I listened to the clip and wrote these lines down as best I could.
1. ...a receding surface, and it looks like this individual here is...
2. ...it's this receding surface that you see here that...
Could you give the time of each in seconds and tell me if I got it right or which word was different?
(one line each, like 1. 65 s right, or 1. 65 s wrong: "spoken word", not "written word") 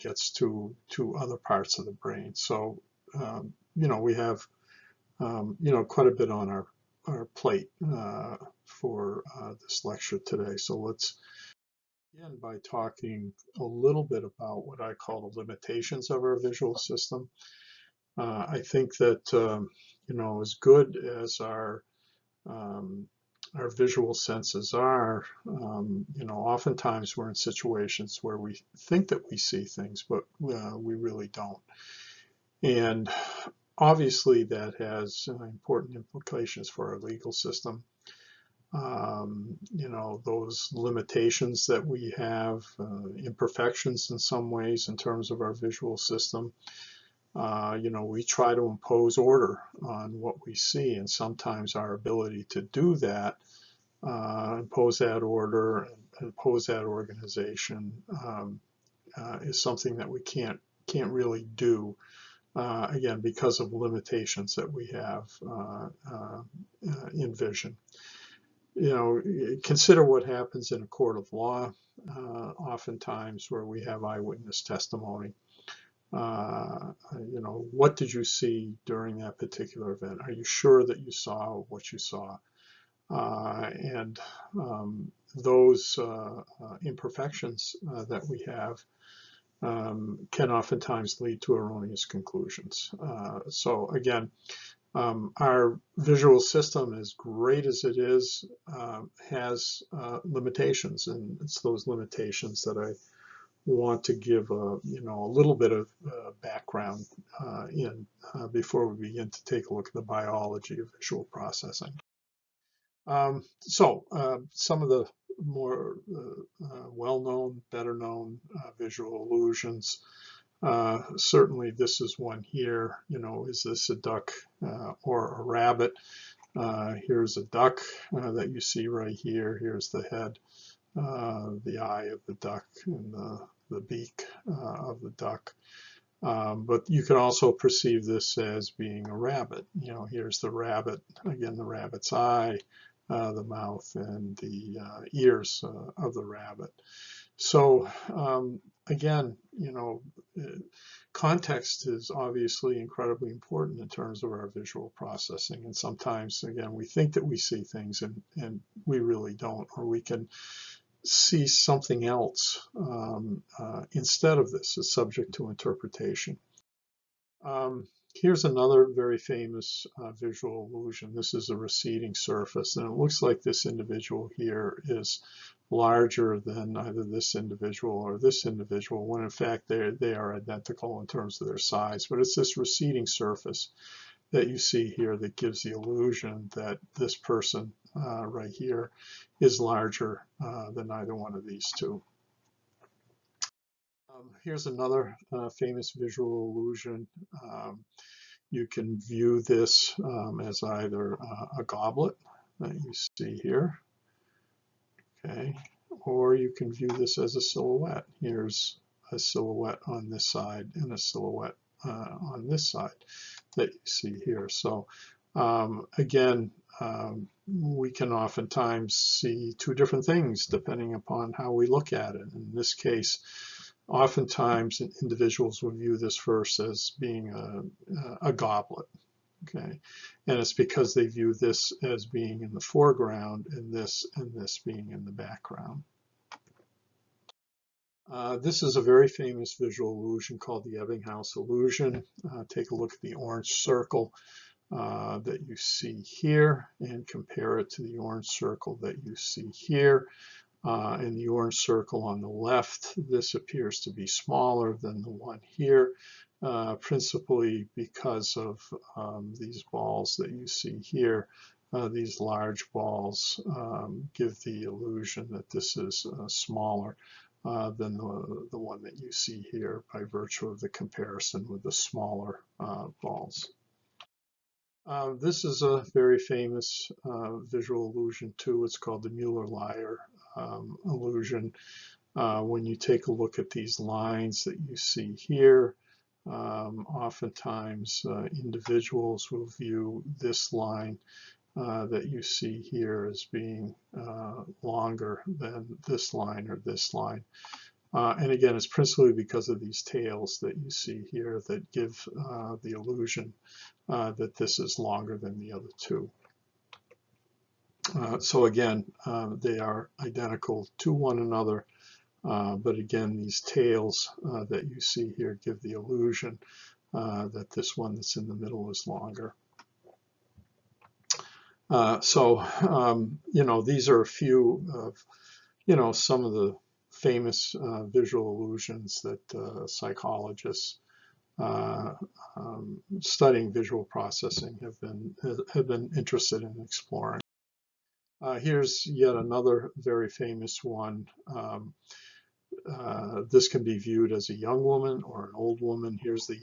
1. 171 s right
2. 182 s right.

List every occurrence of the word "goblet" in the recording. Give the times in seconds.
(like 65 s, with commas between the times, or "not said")
201 s, 228 s.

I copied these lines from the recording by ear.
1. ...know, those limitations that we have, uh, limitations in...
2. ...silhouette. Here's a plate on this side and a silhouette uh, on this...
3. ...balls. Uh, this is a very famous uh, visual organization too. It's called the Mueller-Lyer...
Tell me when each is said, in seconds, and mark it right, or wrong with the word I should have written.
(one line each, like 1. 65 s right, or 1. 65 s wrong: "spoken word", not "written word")
1. 39 s wrong: "imperfections", not "limitations"
2. 207 s wrong: "silhouette", not "plate"
3. 273 s wrong: "illusion", not "organization".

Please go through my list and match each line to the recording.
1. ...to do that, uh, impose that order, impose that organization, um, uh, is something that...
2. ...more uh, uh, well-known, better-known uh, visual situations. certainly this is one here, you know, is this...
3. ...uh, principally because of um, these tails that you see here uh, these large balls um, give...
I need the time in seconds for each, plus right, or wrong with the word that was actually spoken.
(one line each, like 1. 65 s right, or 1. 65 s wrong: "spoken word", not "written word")
1. 52 s right
2. 115 s wrong: "illusions", not "situations"
3. 256 s wrong: "balls", not "tails".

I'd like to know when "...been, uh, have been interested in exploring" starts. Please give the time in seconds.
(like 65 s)
334 s.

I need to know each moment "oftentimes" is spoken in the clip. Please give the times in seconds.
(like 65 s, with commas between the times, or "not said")
26 s, 72 s, 90 s, 218 s, 223 s, 286 s.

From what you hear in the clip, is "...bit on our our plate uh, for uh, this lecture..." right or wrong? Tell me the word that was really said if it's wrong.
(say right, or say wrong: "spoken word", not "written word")
right.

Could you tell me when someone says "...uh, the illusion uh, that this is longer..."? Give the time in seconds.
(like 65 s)
302 s.